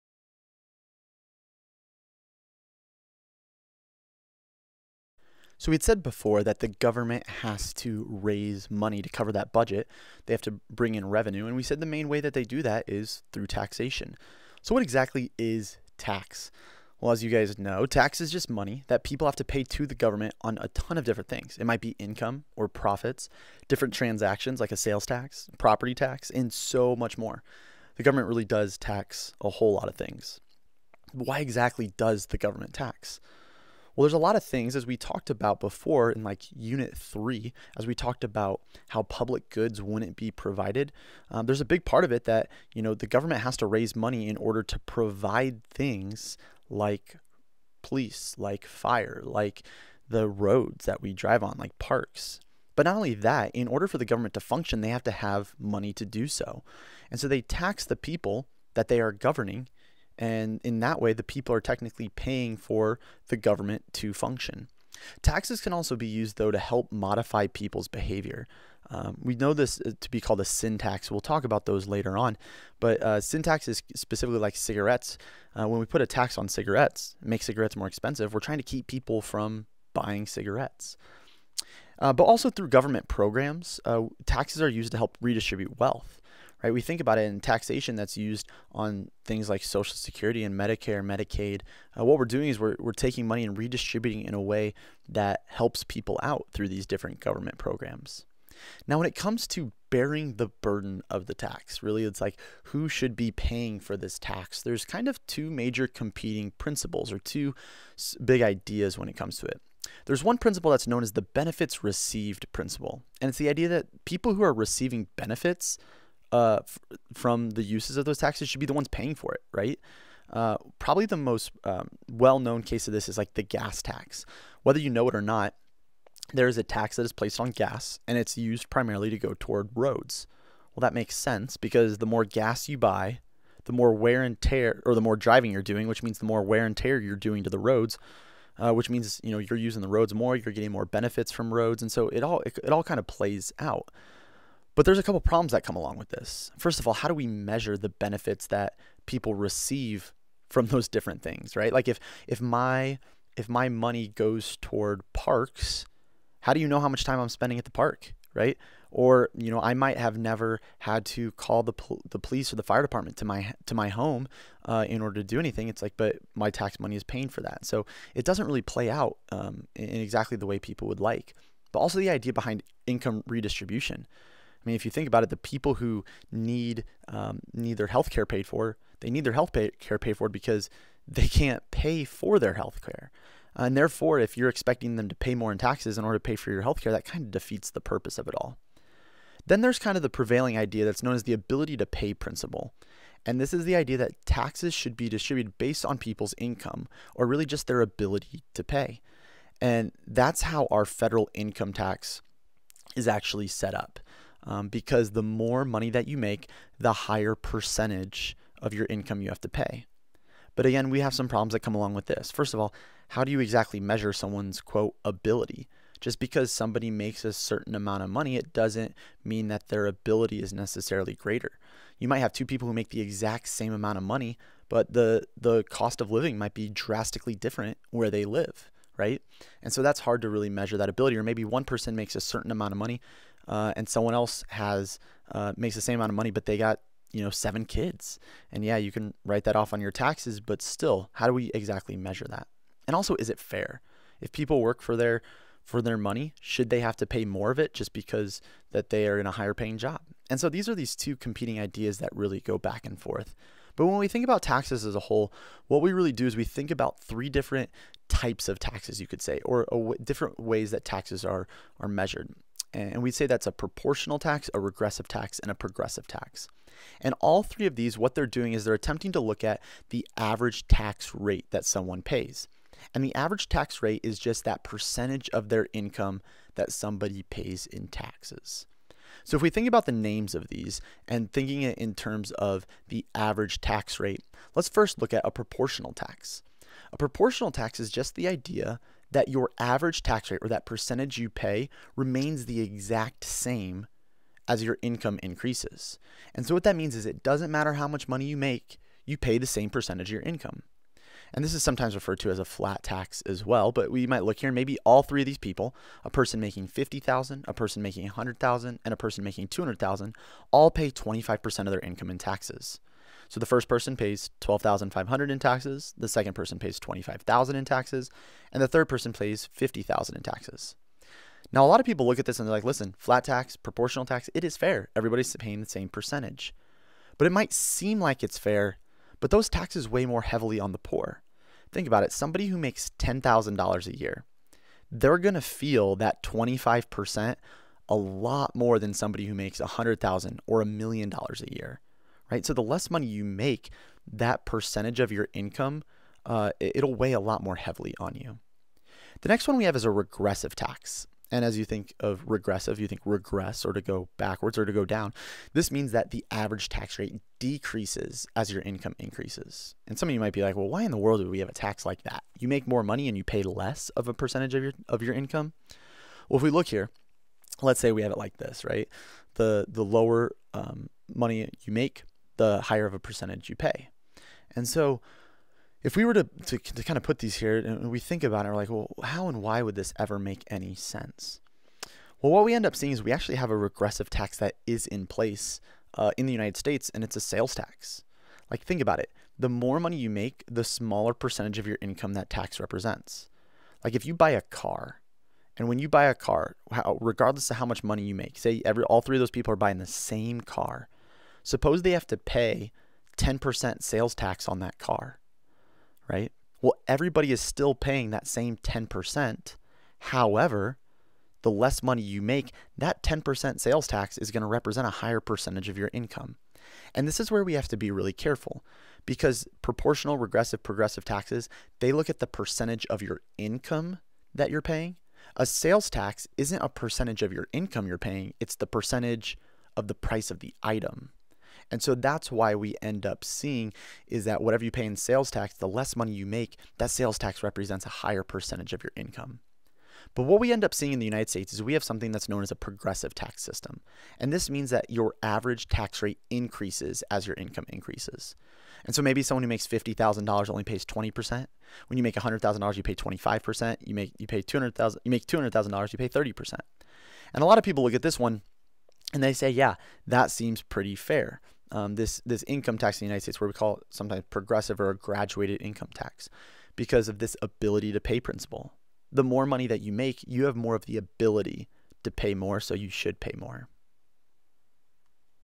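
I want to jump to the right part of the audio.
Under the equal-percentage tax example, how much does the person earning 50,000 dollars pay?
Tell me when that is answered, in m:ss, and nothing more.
5:14.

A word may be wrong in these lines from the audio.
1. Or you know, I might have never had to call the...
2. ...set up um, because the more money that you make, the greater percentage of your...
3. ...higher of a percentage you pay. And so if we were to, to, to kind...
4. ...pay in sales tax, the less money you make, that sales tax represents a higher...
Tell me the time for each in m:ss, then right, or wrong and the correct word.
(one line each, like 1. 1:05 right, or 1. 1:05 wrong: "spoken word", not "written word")
1. 2:38 right
2. 3:23 wrong: "higher", not "greater"
3. 6:12 right
4. 7:14 right.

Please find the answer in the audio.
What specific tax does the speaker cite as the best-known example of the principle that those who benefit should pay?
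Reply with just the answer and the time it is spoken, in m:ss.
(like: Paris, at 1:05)
gas tax, at 2:03.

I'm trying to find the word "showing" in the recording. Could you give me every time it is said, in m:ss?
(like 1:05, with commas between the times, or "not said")
not said.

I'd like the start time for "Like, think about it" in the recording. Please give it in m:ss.
6:28.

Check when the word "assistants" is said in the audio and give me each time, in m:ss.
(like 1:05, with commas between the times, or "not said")
not said.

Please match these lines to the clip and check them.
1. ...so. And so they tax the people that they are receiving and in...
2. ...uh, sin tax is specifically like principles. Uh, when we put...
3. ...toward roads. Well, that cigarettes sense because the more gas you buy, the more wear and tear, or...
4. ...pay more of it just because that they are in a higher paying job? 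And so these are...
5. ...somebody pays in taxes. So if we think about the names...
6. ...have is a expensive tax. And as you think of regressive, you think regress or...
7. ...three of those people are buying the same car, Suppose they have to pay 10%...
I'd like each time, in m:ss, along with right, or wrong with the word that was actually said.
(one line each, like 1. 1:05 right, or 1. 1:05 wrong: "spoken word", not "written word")
1. 0:56 wrong: "governing", not "receiving"
2. 1:13 wrong: "cigarettes", not "principles"
3. 2:09 wrong: "makes", not "cigarettes"
4. 4:07 right
5. 4:36 right
6. 5:49 wrong: "regressive", not "expensive"
7. 6:39 right.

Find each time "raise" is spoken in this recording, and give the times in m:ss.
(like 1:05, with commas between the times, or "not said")
0:08, 0:43.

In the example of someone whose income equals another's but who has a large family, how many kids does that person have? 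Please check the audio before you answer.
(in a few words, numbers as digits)
7.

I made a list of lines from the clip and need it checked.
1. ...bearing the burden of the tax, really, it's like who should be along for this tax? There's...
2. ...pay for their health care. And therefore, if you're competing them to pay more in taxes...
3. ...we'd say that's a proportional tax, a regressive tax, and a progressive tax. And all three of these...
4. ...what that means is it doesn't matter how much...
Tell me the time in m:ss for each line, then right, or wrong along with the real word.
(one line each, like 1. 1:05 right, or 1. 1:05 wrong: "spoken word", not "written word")
1. 1:39 wrong: "paying", not "along"
2. 3:01 wrong: "expecting", not "competing"
3. 4:23 right
4. 4:56 right.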